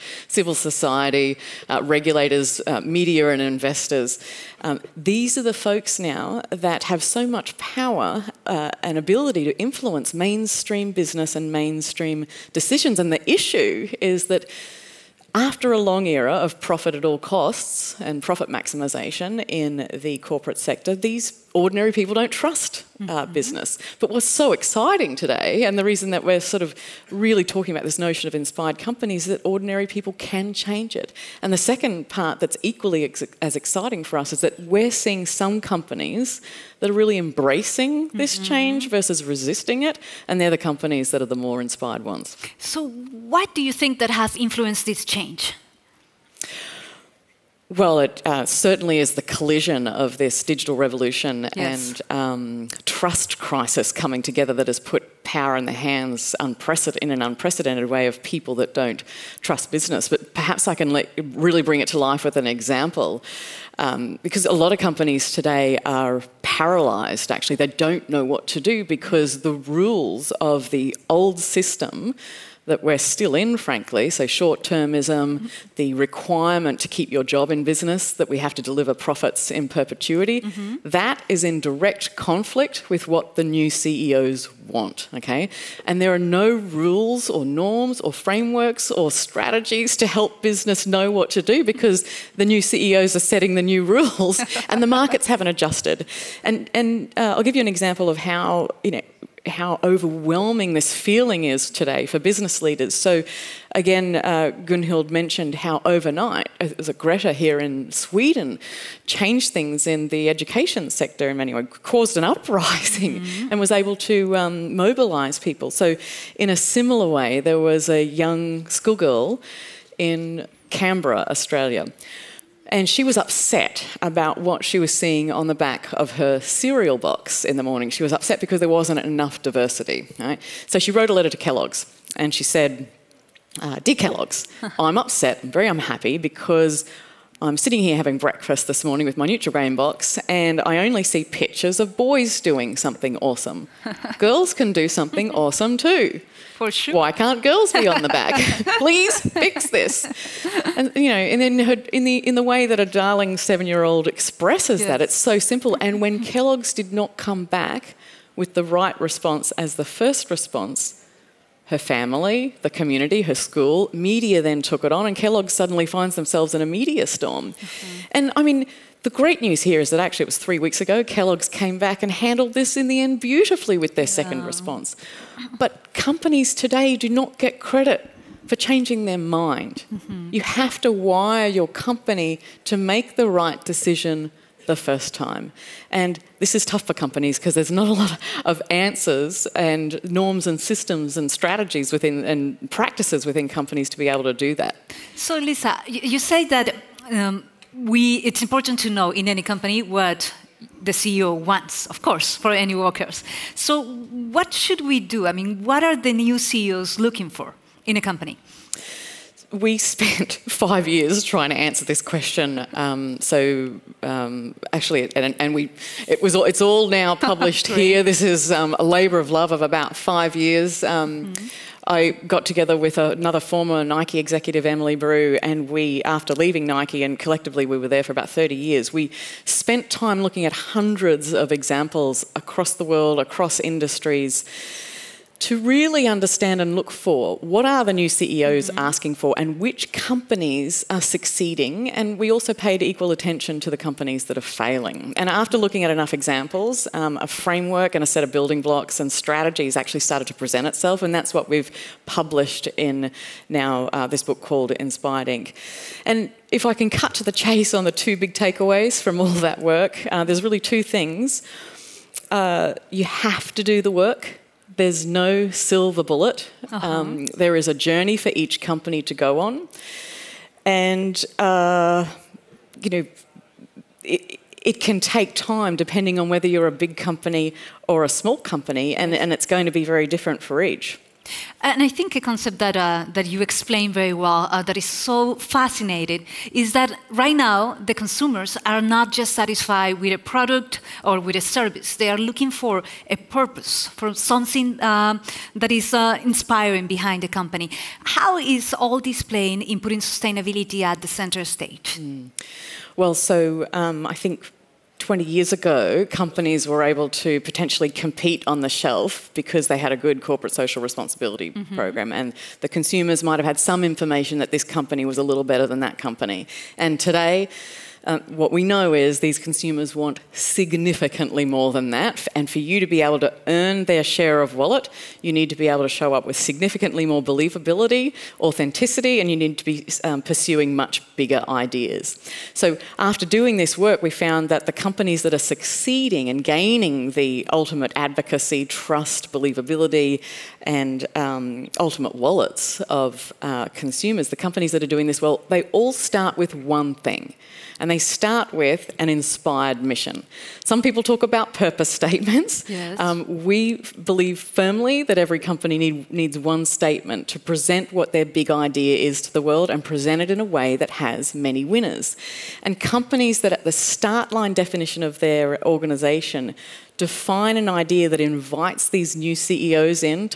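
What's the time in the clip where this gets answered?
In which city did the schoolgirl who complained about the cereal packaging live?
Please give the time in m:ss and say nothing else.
2:00.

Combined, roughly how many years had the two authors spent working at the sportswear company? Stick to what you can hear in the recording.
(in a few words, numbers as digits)
30.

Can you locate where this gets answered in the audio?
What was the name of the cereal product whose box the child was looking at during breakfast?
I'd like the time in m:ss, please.
2:19.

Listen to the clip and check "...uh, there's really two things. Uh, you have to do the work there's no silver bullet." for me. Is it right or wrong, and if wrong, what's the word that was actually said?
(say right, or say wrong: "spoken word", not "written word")
right.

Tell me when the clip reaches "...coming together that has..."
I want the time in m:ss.
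0:53.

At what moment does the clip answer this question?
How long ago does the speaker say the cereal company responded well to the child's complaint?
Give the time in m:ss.
2:50.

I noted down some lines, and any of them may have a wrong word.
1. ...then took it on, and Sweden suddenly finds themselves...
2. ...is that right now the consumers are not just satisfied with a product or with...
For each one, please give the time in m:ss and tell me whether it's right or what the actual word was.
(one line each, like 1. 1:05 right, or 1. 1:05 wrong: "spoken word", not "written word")
1. 2:44 wrong: "Kellogg", not "Sweden"
2. 4:46 right.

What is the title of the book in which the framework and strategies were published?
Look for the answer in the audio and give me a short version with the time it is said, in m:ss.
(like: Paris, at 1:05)
Inspired Inc., at 4:14.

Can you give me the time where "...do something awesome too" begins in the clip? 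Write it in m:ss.
2:24.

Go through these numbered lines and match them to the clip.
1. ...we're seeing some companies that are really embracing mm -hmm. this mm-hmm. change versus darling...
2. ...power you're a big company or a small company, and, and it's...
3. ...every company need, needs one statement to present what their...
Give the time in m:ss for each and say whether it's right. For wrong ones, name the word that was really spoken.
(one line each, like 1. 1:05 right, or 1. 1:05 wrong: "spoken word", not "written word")
1. 0:34 wrong: "resisting", not "darling"
2. 4:36 wrong: "whether", not "power"
3. 5:55 right.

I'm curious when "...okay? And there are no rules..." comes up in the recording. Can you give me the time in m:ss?
1:25.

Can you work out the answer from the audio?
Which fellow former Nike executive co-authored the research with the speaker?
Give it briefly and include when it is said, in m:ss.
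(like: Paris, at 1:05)
Emily Brew, at 3:44.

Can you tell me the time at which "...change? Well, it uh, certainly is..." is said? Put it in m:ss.
0:45.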